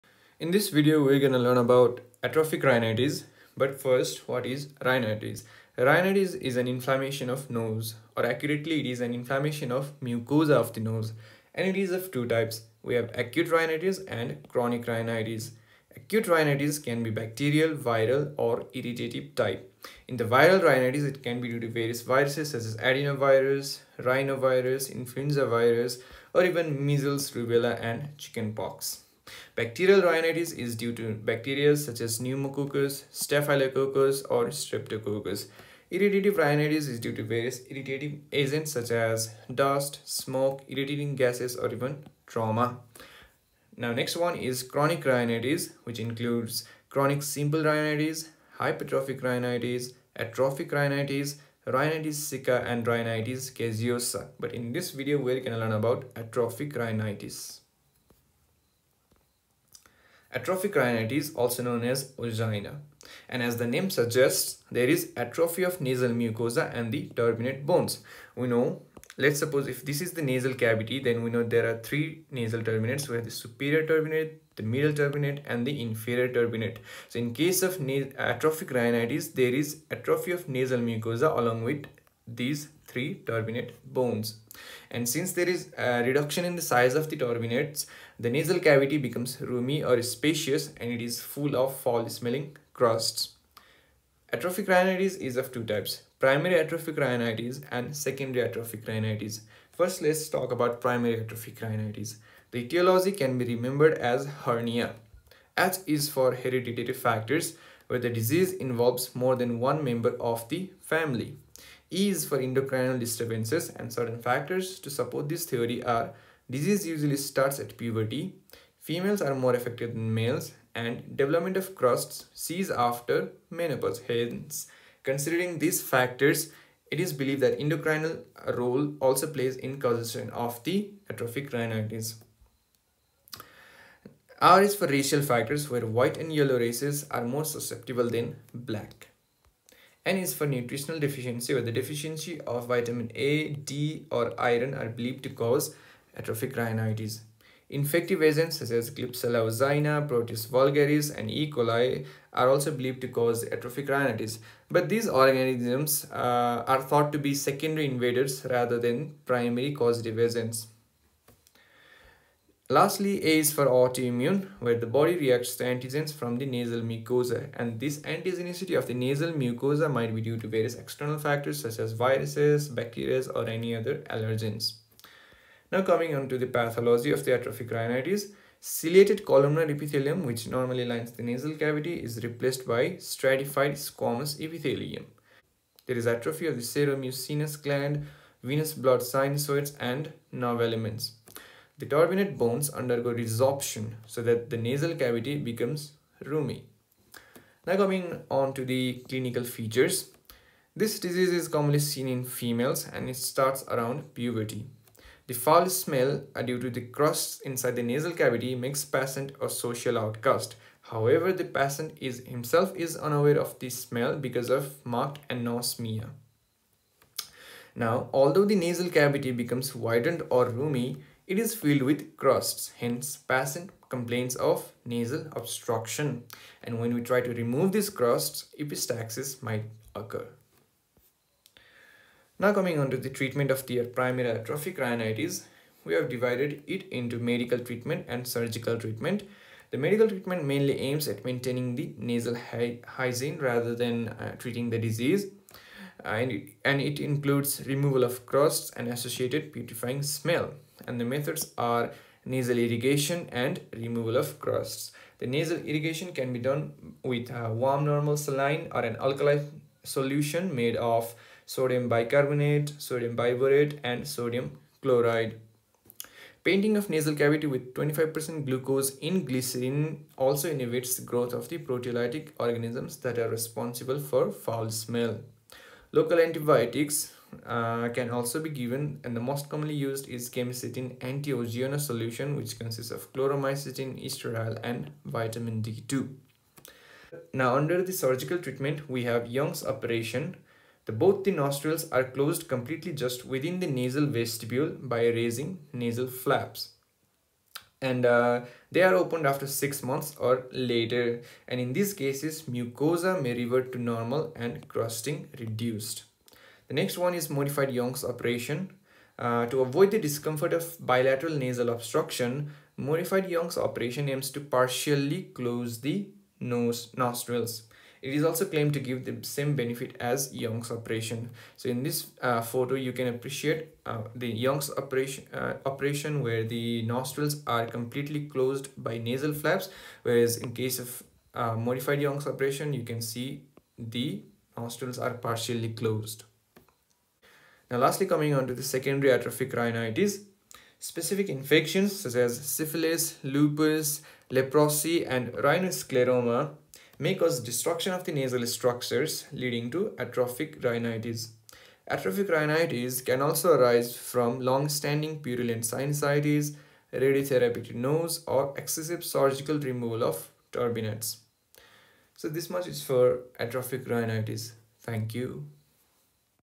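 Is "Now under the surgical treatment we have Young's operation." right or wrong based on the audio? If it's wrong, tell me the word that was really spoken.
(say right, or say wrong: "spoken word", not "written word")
right.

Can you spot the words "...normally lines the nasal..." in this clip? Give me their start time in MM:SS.
03:00.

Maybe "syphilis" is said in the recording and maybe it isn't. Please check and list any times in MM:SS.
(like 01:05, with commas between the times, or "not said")
05:42.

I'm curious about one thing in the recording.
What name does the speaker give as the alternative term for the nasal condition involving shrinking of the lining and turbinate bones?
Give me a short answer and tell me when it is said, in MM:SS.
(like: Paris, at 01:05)
angina, at 01:02.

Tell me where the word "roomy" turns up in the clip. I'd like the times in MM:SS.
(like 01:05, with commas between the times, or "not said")
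01:29, 03:16, 03:40.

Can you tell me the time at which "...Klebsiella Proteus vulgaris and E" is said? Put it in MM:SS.
02:28.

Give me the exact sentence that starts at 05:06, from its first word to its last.
The next one is modified Young's operation.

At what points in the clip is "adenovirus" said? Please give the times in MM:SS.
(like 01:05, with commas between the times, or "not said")
00:22.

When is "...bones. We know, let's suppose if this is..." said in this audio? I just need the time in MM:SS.
01:07.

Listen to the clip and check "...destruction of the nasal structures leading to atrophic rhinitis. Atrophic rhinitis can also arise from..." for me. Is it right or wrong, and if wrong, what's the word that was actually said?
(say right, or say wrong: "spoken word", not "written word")
right.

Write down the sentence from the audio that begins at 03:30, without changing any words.
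However, the patient is himself is unaware of this smell because of marked anosmia.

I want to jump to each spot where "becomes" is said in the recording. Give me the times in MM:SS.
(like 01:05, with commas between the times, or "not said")
01:28, 03:15, 03:39.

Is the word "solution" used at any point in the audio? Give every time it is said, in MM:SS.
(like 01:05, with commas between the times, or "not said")
04:19, 04:41.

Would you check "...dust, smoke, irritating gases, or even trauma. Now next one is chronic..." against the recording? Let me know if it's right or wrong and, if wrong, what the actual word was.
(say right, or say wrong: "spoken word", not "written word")
right.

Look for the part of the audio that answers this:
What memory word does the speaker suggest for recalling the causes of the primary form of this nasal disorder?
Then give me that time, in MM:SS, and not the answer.
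01:44.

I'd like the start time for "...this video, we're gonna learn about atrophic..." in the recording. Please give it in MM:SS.
00:00.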